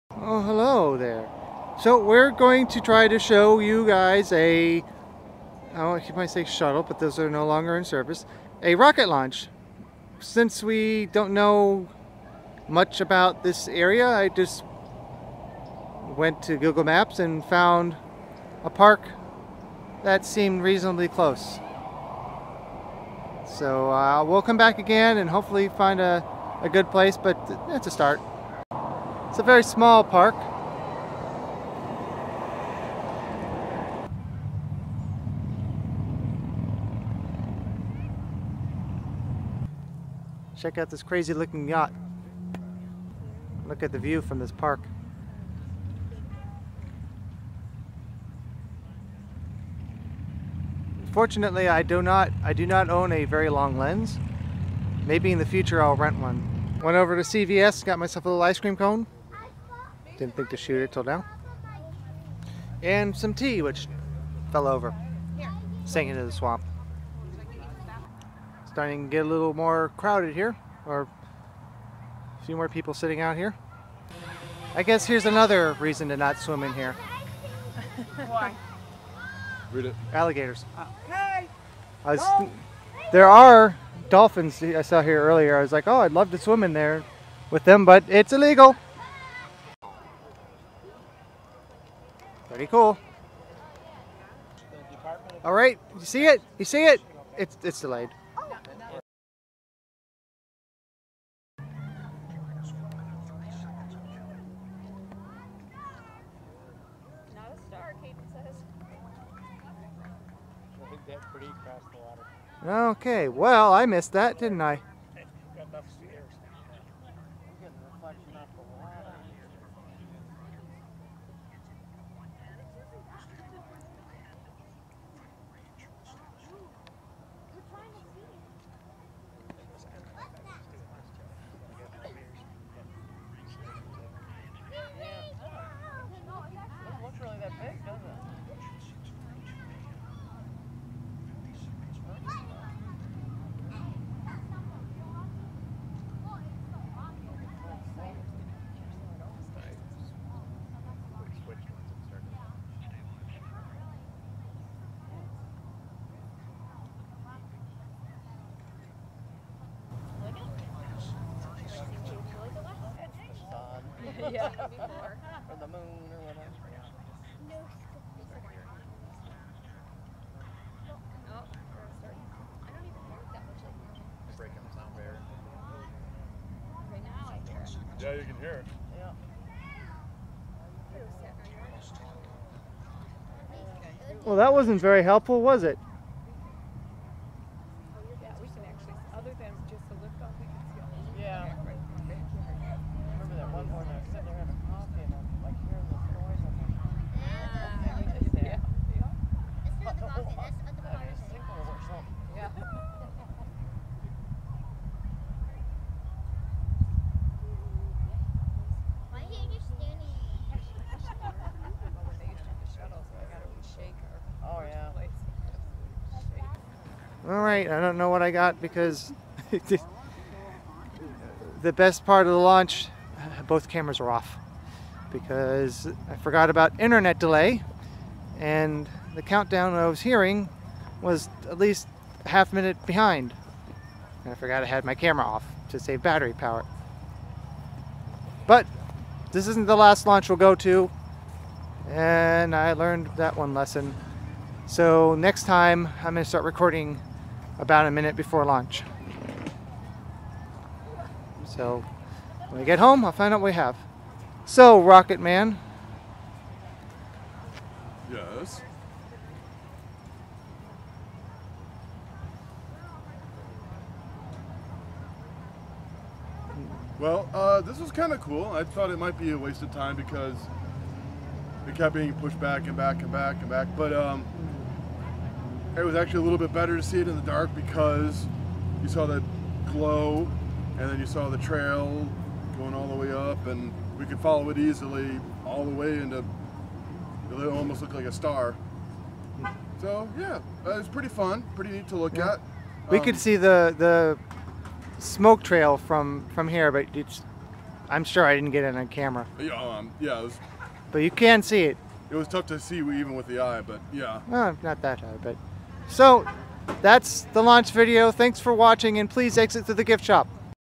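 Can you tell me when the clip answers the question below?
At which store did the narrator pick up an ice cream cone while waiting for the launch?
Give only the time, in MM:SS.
00:57.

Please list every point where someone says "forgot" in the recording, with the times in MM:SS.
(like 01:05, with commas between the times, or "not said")
03:46, 03:54.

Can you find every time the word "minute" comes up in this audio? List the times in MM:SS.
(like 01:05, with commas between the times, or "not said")
03:52, 04:07.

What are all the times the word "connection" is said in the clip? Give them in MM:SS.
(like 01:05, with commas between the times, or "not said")
not said.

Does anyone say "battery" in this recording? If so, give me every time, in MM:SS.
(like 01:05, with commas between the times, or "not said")
03:56.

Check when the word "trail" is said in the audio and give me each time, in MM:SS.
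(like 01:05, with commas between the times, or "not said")
04:41, 04:55.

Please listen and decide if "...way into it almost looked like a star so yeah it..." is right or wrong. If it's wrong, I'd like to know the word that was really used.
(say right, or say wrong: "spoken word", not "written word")
right.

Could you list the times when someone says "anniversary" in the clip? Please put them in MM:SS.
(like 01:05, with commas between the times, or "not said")
not said.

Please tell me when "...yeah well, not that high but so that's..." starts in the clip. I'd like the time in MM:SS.
05:03.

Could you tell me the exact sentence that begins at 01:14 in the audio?
I guess here's another reason to not swim in here.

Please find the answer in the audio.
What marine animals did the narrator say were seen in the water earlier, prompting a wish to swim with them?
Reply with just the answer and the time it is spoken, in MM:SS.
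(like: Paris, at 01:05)
Dolphins, at 01:24.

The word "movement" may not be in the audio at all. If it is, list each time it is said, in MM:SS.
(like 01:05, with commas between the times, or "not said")
not said.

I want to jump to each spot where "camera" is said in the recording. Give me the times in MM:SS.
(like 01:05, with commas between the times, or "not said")
03:43, 03:54, 04:58.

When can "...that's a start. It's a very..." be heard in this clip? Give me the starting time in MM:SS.
00:27.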